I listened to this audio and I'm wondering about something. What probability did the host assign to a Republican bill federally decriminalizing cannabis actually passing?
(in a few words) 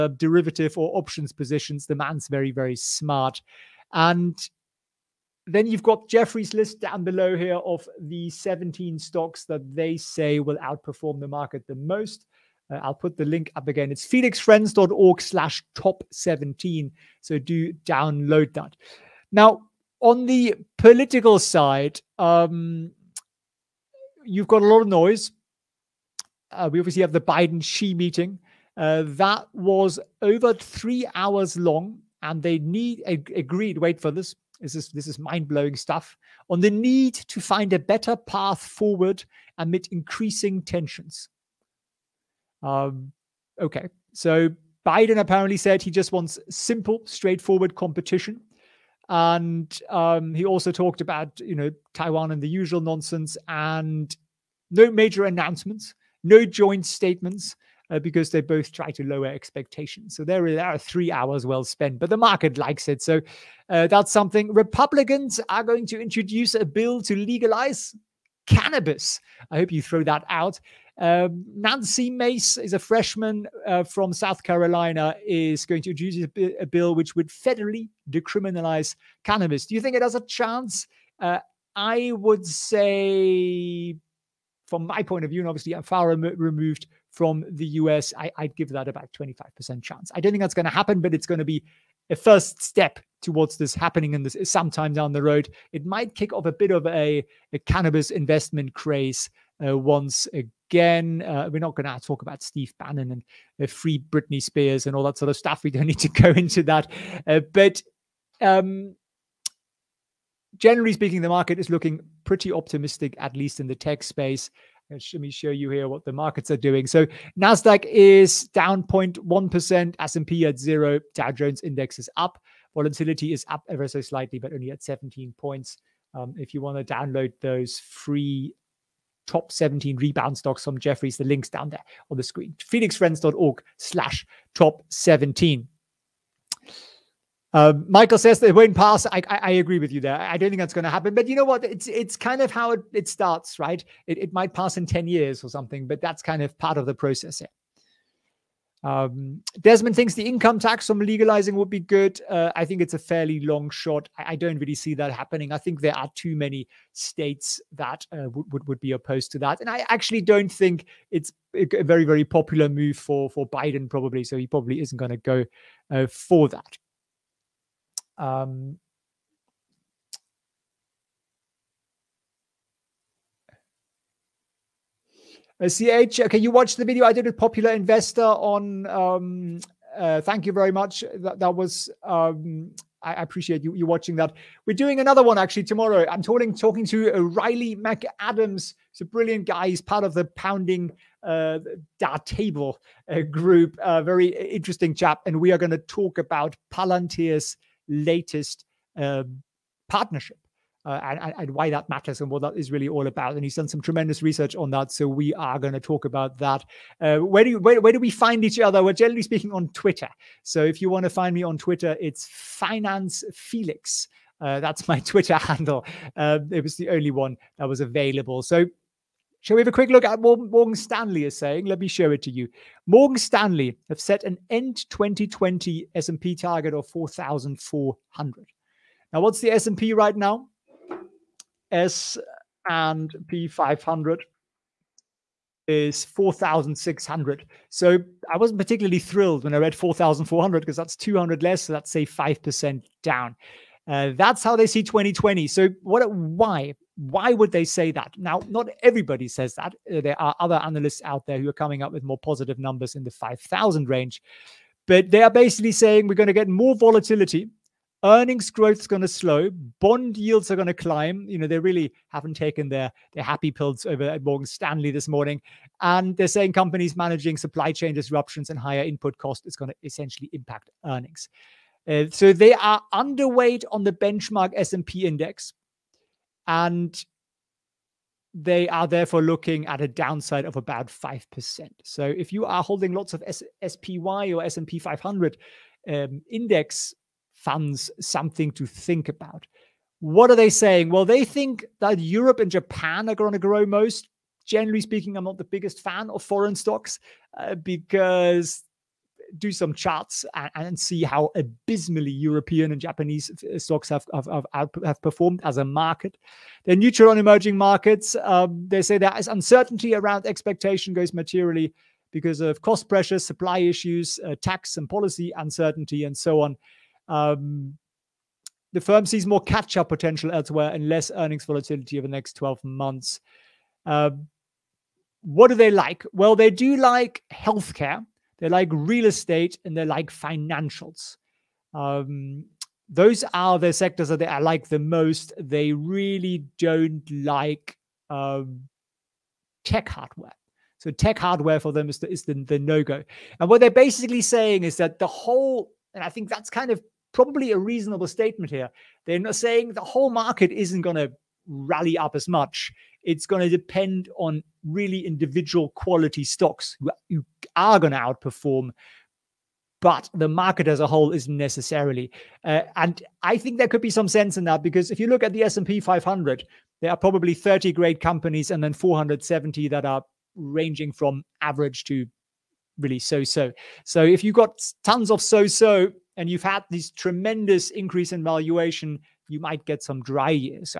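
25%.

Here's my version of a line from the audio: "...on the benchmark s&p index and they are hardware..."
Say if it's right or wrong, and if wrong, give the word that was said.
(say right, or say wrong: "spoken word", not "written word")
wrong: "therefore", not "hardware".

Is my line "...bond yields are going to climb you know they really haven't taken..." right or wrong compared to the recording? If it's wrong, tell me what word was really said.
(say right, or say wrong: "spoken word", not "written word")
right.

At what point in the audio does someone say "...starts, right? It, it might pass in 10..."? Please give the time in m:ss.
2:23.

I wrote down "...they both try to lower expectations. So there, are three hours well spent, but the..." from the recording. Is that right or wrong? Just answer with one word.
right.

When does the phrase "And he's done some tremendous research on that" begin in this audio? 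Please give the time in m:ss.
3:23.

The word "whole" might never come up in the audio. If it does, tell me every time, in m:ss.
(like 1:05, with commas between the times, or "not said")
5:45, 5:49, 6:00.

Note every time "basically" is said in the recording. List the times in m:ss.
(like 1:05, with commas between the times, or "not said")
4:15, 5:43.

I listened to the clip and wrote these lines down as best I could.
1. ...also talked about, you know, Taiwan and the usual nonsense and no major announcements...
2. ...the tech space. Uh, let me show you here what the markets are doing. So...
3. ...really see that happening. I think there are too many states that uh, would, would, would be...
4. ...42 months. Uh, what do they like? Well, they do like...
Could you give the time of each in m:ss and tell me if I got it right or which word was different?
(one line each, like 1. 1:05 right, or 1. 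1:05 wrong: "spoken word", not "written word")
1. 0:50 right
2. 1:53 right
3. 2:34 right
4. 5:22 wrong: "12", not "42".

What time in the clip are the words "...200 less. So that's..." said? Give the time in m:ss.
4:00.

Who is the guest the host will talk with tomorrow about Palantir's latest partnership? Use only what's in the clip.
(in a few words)
Riley McAdams.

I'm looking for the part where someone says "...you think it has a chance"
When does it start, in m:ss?
1:19.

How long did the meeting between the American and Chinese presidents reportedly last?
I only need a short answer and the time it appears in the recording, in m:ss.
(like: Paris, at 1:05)
over three hours, at 0:30.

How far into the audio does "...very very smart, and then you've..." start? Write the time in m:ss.
0:02.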